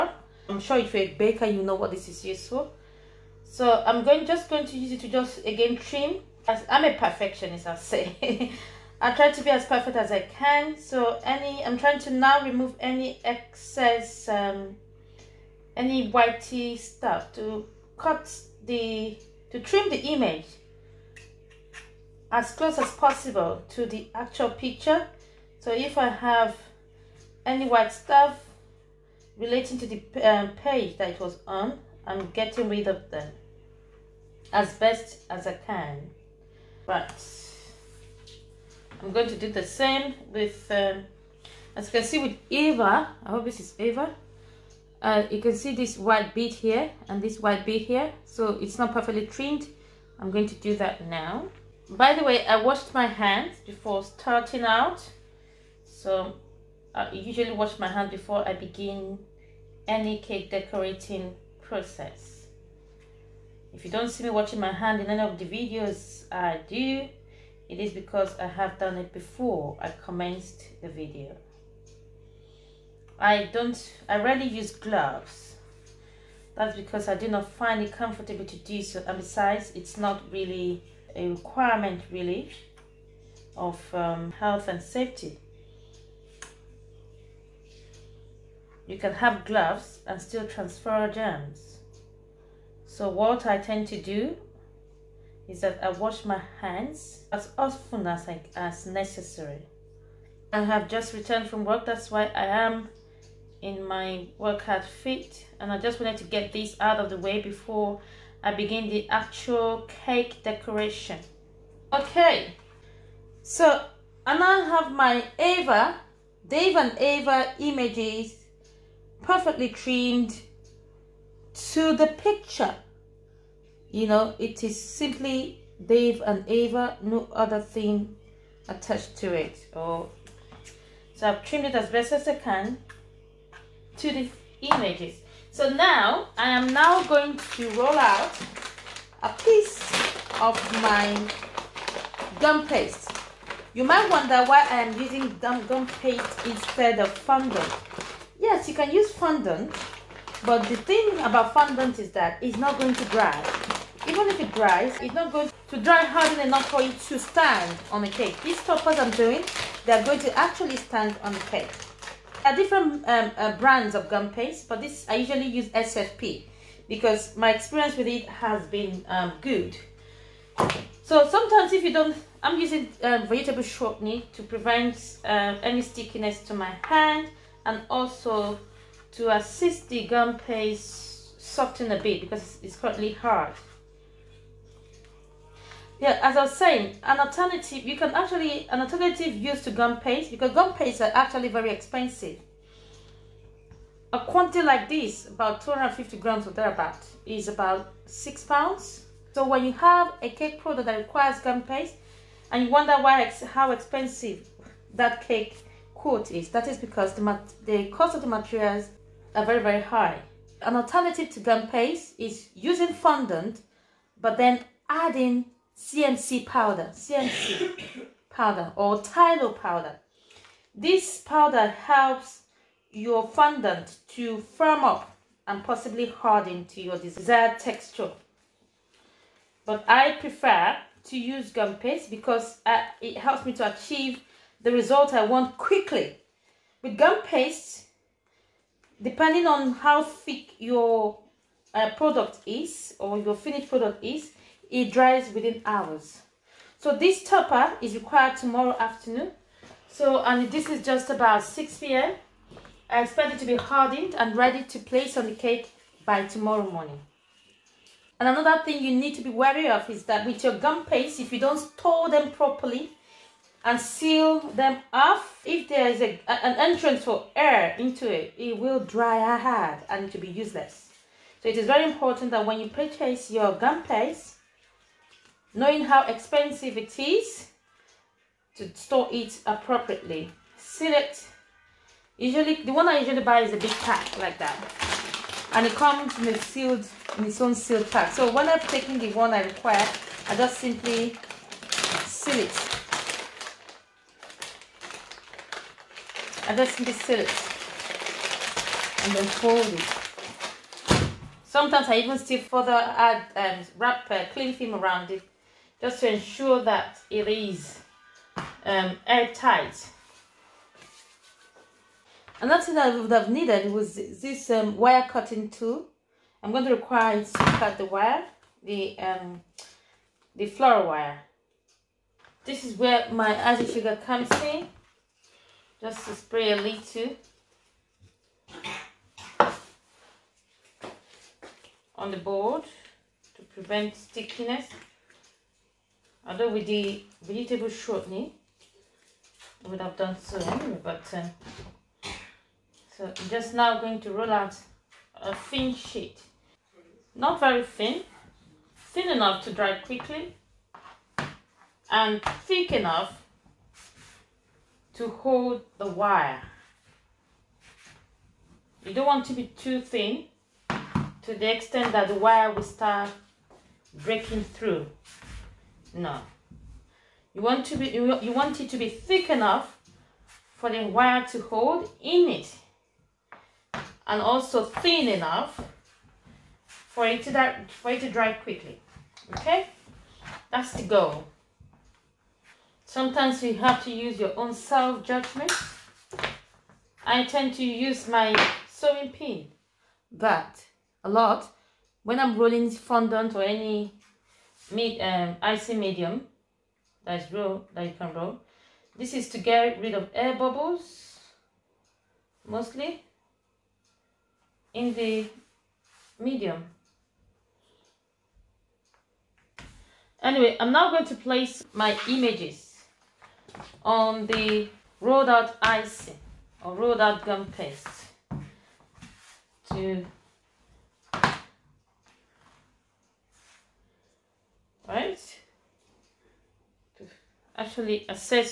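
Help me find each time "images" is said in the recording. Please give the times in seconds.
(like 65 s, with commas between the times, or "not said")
19 s, 117 s, 134 s, 412 s.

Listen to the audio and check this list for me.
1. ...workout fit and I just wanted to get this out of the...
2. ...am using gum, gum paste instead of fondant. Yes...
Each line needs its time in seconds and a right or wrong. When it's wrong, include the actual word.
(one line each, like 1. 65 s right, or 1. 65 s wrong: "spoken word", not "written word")
1. 104 s right
2. 144 s right.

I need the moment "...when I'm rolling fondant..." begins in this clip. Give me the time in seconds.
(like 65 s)
392 s.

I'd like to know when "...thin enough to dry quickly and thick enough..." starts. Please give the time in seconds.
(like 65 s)
348 s.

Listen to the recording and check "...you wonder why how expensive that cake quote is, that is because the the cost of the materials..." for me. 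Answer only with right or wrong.
right.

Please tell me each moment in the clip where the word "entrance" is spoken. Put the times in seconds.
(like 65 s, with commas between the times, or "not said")
266 s.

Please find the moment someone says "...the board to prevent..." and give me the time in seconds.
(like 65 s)
332 s.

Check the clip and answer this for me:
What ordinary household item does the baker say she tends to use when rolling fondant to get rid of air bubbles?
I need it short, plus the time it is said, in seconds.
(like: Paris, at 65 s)
Sewing pin, at 388 s.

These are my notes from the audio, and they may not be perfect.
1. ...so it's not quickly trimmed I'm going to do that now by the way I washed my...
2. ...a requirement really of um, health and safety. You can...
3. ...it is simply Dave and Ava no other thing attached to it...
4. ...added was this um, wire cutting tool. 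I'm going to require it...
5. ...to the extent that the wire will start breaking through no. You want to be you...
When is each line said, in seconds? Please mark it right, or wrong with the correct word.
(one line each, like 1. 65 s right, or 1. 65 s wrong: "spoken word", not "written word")
1. 48 s wrong: "perfectly", not "quickly"
2. 81 s right
3. 124 s right
4. 313 s wrong: "needed", not "added"
5. 361 s right.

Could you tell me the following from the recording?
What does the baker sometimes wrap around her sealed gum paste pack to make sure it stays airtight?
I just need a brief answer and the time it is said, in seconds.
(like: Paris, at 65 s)
Cling film, at 304 s.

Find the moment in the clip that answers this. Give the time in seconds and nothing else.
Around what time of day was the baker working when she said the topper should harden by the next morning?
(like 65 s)
251 s.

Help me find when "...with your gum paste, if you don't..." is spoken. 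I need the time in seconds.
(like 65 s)
260 s.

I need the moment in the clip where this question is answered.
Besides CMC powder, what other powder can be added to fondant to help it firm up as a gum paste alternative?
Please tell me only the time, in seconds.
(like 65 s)
219 s.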